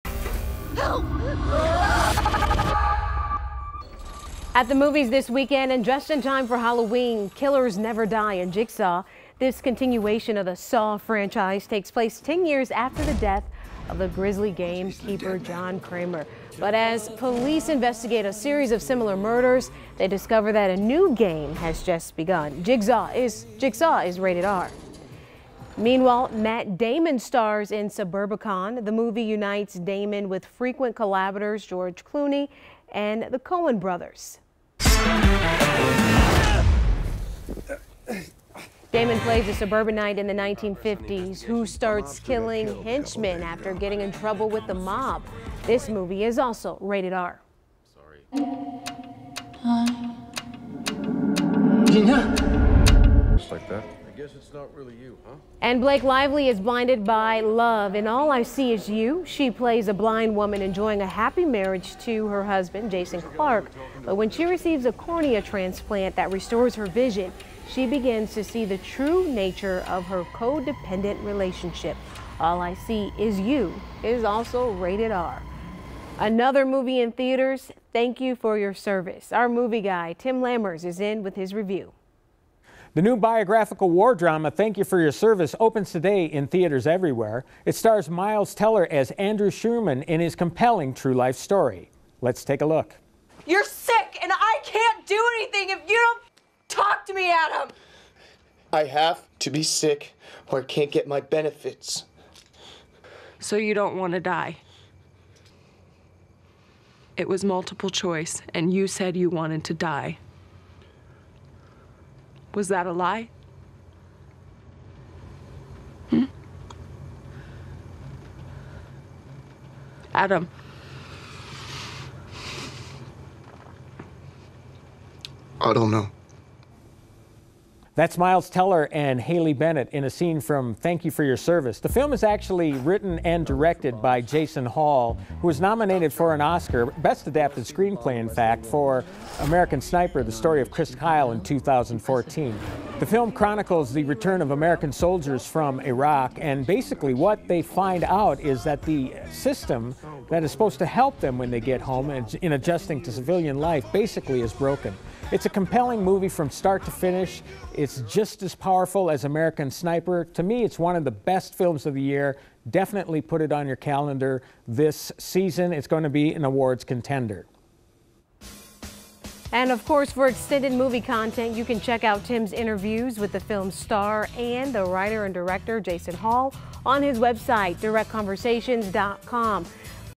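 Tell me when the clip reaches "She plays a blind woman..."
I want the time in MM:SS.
00:59.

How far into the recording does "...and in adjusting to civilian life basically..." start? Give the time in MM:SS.
02:32.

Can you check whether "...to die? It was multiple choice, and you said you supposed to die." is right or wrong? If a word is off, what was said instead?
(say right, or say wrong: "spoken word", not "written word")
wrong: "wanted", not "supposed".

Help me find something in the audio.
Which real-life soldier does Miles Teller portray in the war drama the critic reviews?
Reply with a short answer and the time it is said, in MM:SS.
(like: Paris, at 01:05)
Andrew Sherman, at 01:29.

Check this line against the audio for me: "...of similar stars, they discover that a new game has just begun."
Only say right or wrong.
wrong.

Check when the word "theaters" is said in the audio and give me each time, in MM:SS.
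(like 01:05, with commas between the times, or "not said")
01:17, 01:26.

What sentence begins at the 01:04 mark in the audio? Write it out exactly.
But when she receives a cornea transplant that restores her vision, she begins to see the true nature of her codependent relationship.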